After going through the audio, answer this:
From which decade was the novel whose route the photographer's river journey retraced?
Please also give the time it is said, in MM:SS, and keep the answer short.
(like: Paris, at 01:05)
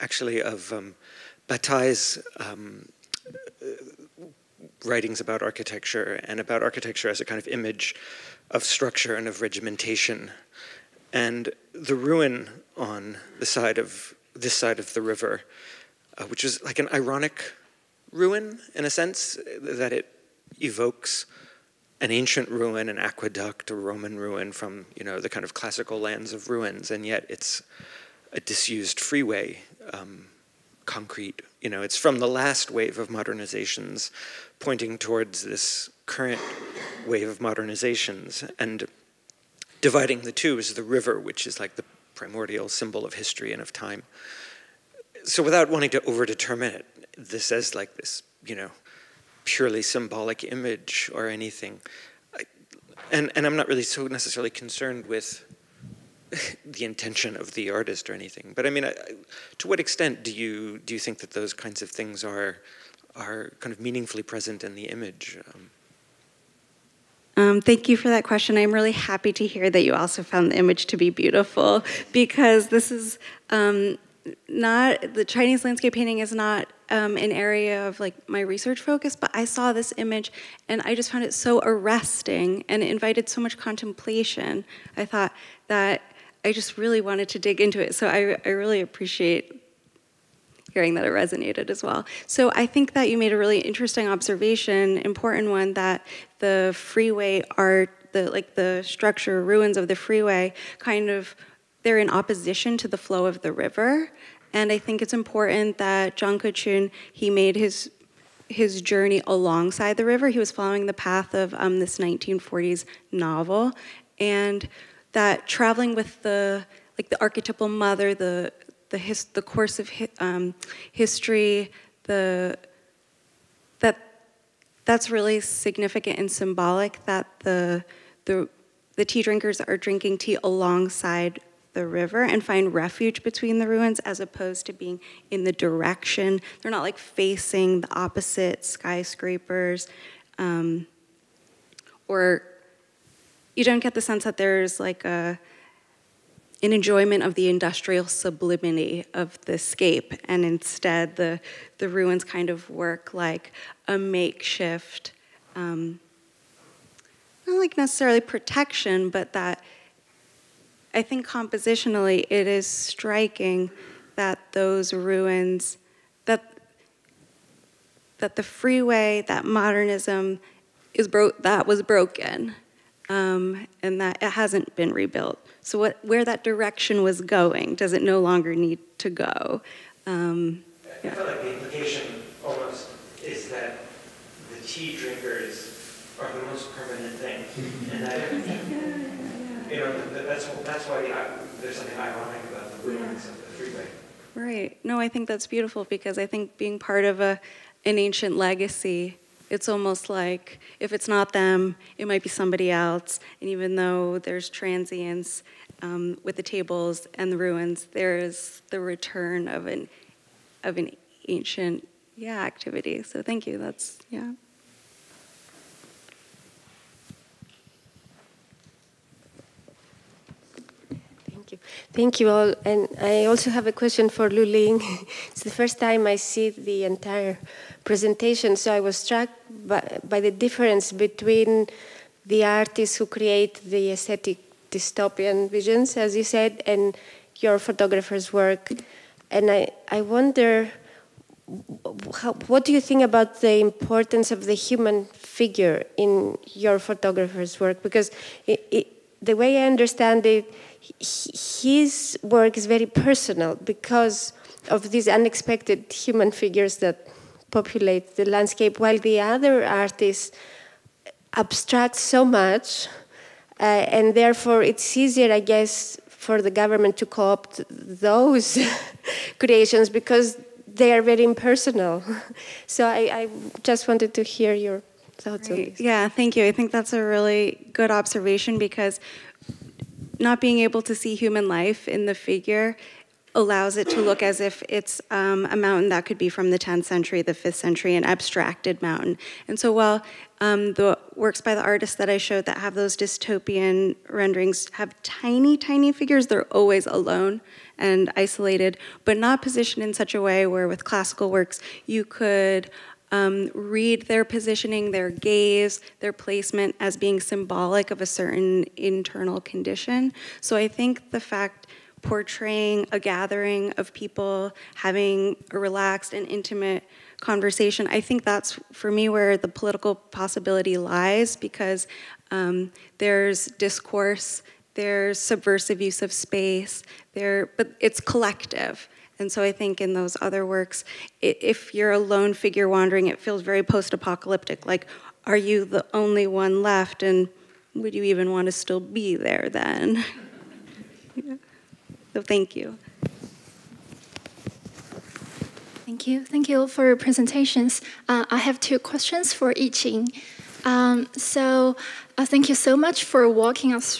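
1940s, at 01:51.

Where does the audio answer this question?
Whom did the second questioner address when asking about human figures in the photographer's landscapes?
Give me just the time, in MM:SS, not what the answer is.
03:44.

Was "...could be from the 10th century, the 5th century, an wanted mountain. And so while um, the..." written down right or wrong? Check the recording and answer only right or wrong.
wrong.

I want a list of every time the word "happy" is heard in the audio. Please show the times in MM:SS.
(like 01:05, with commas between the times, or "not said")
01:08.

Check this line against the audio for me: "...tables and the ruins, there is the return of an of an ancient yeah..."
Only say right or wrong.
right.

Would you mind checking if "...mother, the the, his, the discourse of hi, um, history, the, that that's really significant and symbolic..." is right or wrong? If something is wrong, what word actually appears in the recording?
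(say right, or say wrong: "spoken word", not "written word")
wrong: "course", not "discourse".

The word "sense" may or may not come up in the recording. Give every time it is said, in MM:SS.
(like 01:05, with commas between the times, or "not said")
00:18, 02:23.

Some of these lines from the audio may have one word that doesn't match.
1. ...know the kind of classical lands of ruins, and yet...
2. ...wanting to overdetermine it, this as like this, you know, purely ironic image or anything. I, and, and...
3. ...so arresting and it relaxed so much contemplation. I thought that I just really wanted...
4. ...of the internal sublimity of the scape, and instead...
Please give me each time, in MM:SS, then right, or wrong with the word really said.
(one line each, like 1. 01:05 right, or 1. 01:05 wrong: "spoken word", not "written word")
1. 00:25 right
2. 00:45 wrong: "symbolic", not "ironic"
3. 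01:21 wrong: "invited", not "relaxed"
4. 02:27 wrong: "industrial", not "internal".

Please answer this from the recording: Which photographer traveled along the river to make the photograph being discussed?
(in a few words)
Zhang Kechun.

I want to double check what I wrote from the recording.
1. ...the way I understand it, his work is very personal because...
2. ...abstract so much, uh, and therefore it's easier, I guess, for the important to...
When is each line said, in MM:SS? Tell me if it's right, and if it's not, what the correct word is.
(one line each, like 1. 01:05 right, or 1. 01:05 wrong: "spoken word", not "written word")
1. 04:09 right
2. 04:21 wrong: "government", not "important".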